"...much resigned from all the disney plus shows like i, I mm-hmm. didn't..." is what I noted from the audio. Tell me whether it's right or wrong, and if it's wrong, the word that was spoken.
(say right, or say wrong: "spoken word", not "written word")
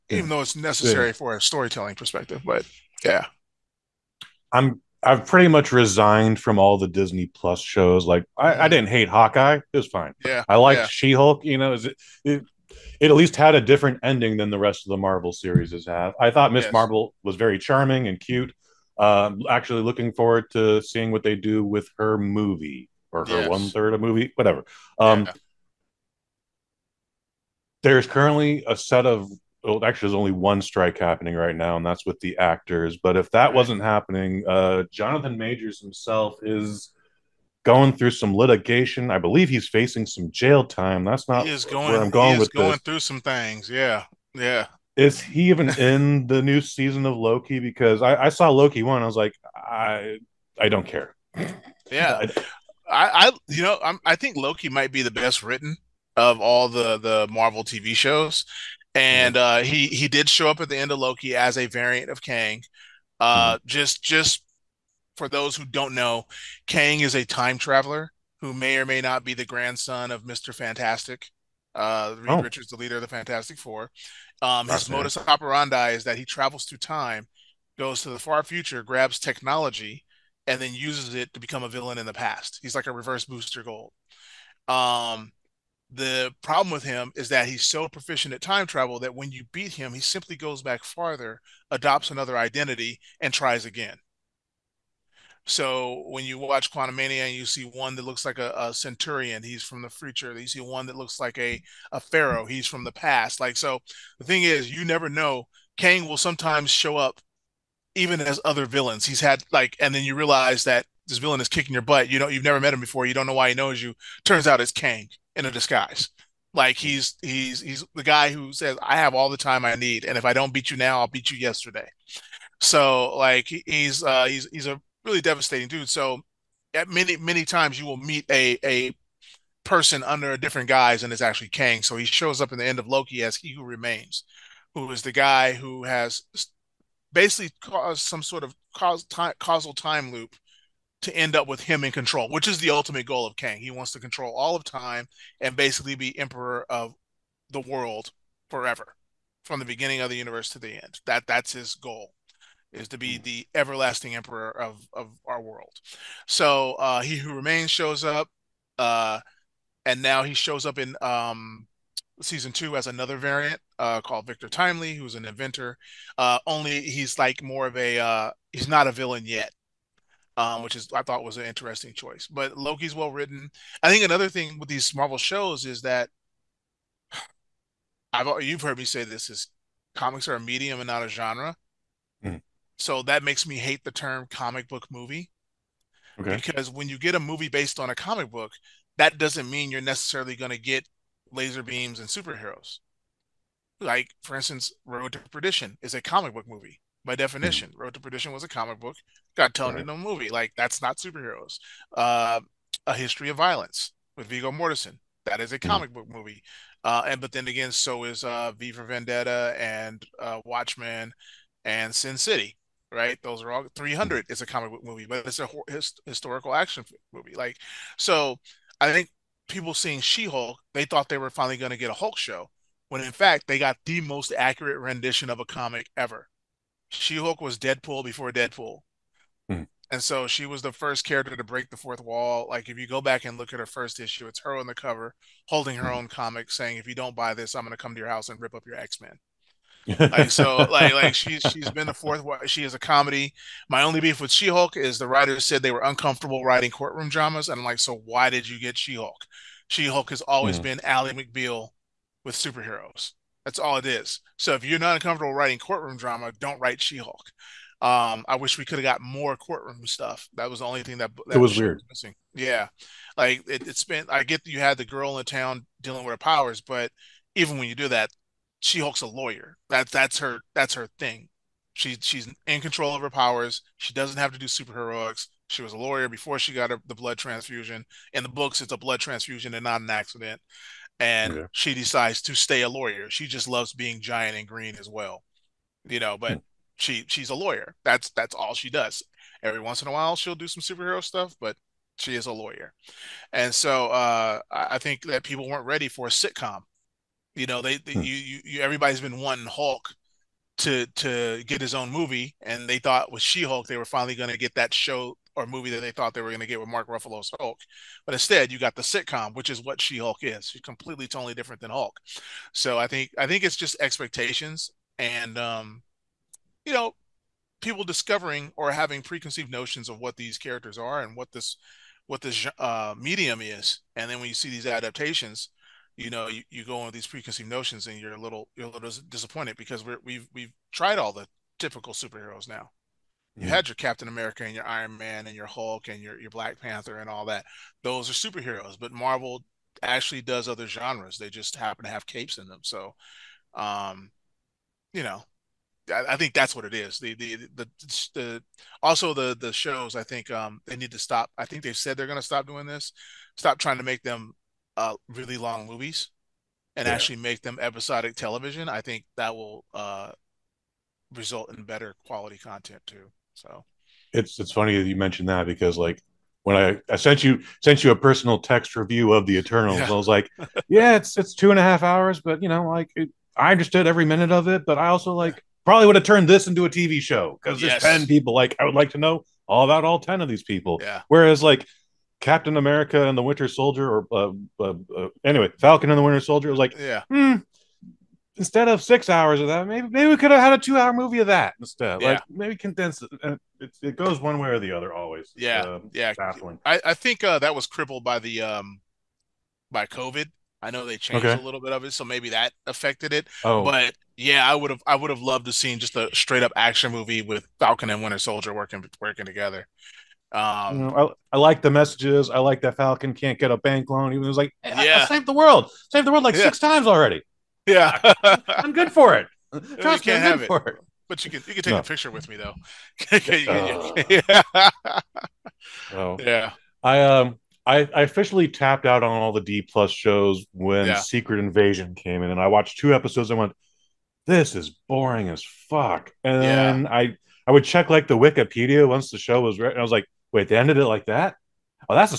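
right.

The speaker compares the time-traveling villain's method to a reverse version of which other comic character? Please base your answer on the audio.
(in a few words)
Booster Gold.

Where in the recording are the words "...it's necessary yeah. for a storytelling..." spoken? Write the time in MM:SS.
00:00.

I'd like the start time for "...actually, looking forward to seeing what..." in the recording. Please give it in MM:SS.
00:19.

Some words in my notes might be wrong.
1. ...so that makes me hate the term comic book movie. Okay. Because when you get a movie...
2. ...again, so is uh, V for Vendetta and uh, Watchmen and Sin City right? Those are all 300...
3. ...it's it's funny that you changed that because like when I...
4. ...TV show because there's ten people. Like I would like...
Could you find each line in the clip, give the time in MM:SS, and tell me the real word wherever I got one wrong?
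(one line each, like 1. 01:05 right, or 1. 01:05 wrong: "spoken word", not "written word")
1. 03:02 right
2. 03:27 right
3. 06:04 wrong: "mentioned", not "changed"
4. 06:16 right.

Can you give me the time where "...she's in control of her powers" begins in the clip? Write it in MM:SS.
04:31.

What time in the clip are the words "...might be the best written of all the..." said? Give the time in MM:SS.
00:54.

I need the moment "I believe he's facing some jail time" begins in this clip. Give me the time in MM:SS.
00:39.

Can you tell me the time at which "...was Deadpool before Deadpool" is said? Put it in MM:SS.
03:47.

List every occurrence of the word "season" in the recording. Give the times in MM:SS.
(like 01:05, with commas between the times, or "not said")
00:46, 02:42.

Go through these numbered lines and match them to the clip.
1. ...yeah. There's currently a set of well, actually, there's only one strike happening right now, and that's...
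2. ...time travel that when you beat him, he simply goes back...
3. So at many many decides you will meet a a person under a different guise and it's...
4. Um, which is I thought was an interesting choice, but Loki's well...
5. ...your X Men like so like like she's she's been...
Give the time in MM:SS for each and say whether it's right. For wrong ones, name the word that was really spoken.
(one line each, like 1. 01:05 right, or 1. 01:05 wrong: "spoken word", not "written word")
1. 00:25 right
2. 01:28 right
3. 02:05 wrong: "times", not "decides"
4. 02:50 right
5. 03:58 right.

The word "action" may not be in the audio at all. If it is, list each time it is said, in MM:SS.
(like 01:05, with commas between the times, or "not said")
03:36, 06:46.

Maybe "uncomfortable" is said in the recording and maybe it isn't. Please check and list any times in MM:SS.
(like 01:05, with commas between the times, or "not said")
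04:05, 04:14.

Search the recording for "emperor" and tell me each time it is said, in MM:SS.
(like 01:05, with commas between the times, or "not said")
02:26, 02:34.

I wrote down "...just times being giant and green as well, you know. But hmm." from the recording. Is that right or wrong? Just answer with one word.
wrong.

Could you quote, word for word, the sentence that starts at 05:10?
She's completely totally different than Hulk.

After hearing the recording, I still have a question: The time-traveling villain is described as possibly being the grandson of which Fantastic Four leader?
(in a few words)
Mister Fantastic.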